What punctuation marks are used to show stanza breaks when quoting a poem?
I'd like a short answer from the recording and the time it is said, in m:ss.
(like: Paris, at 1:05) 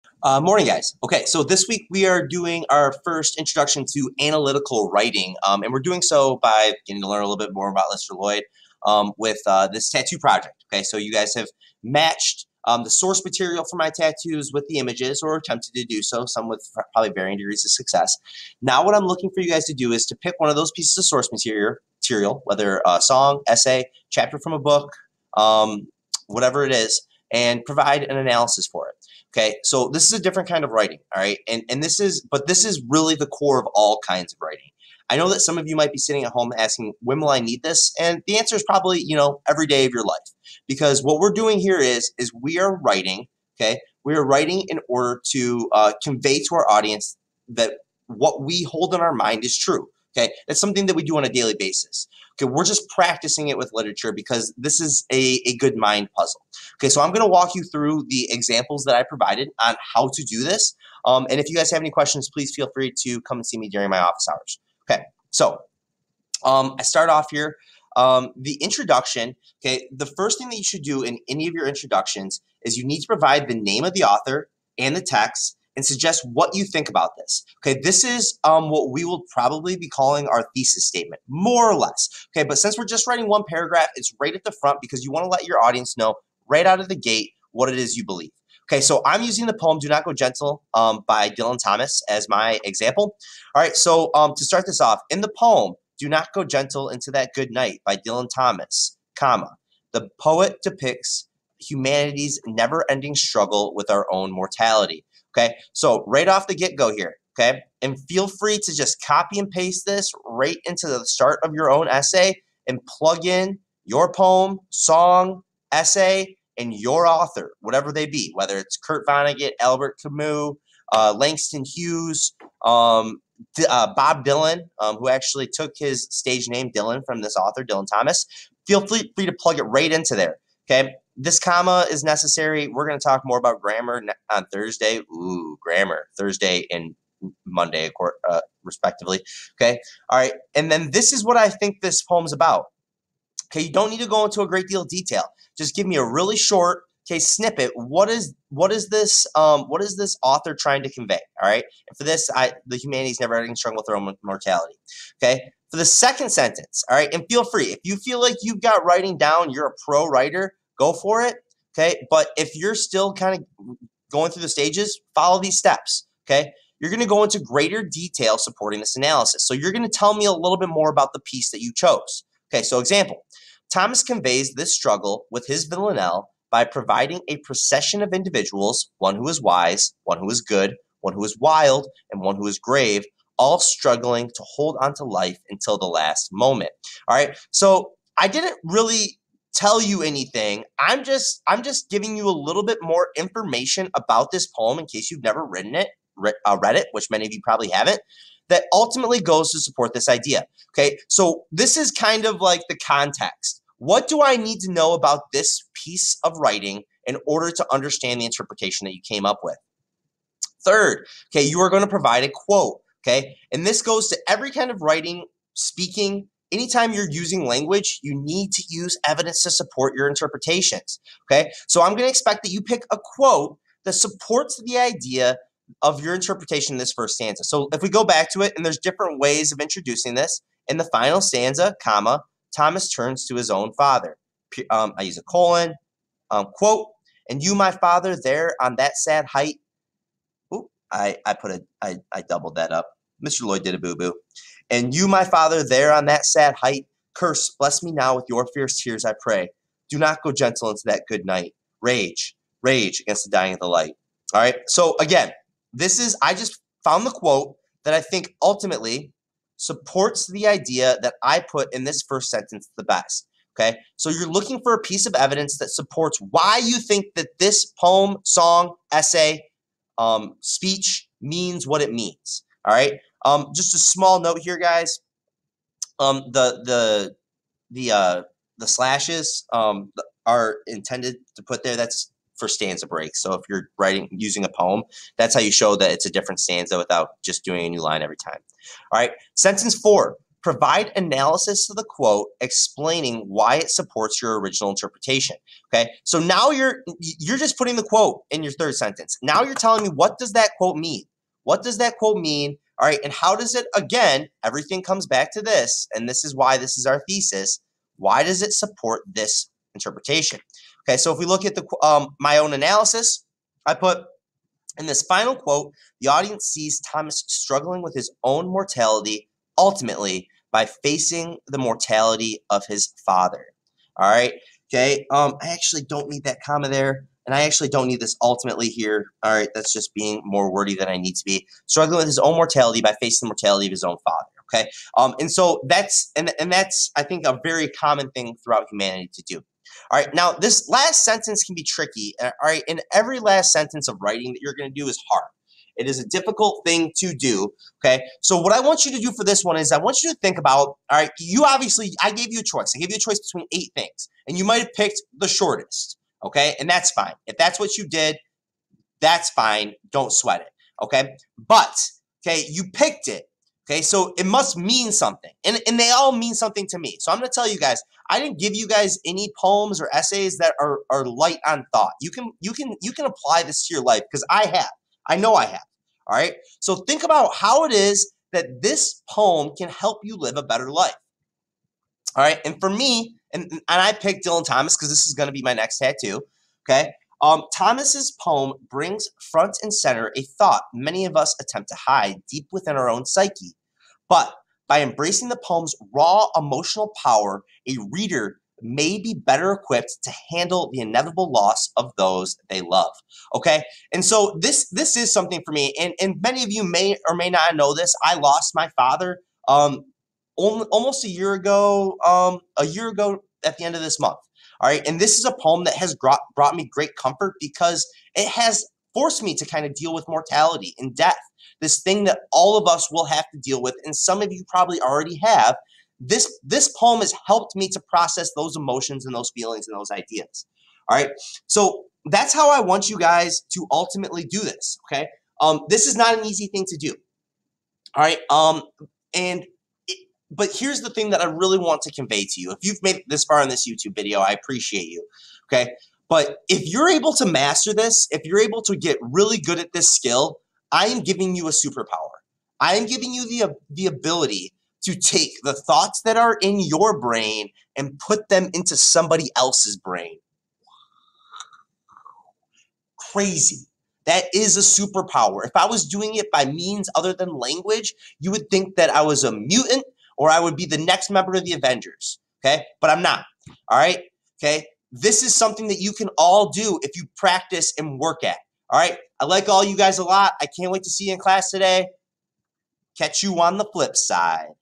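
slashes, at 4:38.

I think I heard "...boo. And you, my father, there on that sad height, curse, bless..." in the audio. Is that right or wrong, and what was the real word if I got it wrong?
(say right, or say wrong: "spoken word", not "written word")
right.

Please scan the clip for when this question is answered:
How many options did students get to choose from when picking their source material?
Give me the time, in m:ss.
5:53.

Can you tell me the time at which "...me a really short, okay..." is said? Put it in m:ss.
2:25.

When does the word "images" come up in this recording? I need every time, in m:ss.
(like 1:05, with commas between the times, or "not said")
0:14.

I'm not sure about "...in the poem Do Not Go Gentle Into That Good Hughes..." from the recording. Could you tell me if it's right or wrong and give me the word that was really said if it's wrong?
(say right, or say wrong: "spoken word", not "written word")
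wrong: "Night", not "Hughes".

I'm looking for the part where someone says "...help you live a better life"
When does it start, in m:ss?
6:19.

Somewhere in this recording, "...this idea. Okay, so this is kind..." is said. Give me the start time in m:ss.
3:19.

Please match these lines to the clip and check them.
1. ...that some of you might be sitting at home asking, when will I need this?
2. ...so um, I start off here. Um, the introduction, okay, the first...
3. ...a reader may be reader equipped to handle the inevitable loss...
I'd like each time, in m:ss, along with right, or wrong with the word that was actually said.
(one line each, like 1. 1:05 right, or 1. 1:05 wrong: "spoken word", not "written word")
1. 0:35 right
2. 1:05 right
3. 6:37 wrong: "better", not "reader".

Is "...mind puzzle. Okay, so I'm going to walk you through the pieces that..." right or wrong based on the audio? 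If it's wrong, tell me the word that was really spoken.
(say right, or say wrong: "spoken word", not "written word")
wrong: "examples", not "pieces".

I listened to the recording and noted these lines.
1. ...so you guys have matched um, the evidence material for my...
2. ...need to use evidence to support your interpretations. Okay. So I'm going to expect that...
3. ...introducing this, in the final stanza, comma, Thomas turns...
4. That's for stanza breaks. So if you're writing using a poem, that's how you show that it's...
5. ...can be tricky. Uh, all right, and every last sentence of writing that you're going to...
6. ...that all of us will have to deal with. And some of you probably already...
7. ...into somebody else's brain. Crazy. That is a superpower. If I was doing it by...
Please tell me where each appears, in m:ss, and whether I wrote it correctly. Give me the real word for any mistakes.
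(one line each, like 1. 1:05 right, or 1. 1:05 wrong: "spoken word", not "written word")
1. 0:10 wrong: "source", not "evidence"
2. 3:38 right
3. 3:49 right
4. 4:41 right
5. 5:41 right
6. 7:02 right
7. 7:38 right.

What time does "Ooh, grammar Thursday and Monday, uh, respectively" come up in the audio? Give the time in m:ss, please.
2:15.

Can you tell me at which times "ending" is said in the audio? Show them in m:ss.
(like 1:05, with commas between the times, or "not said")
1:42, 2:33.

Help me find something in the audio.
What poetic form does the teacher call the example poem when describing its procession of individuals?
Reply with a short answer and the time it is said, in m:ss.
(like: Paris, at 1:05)
villanelle, at 2:55.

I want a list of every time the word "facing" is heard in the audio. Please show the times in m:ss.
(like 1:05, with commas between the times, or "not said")
5:20, 5:33.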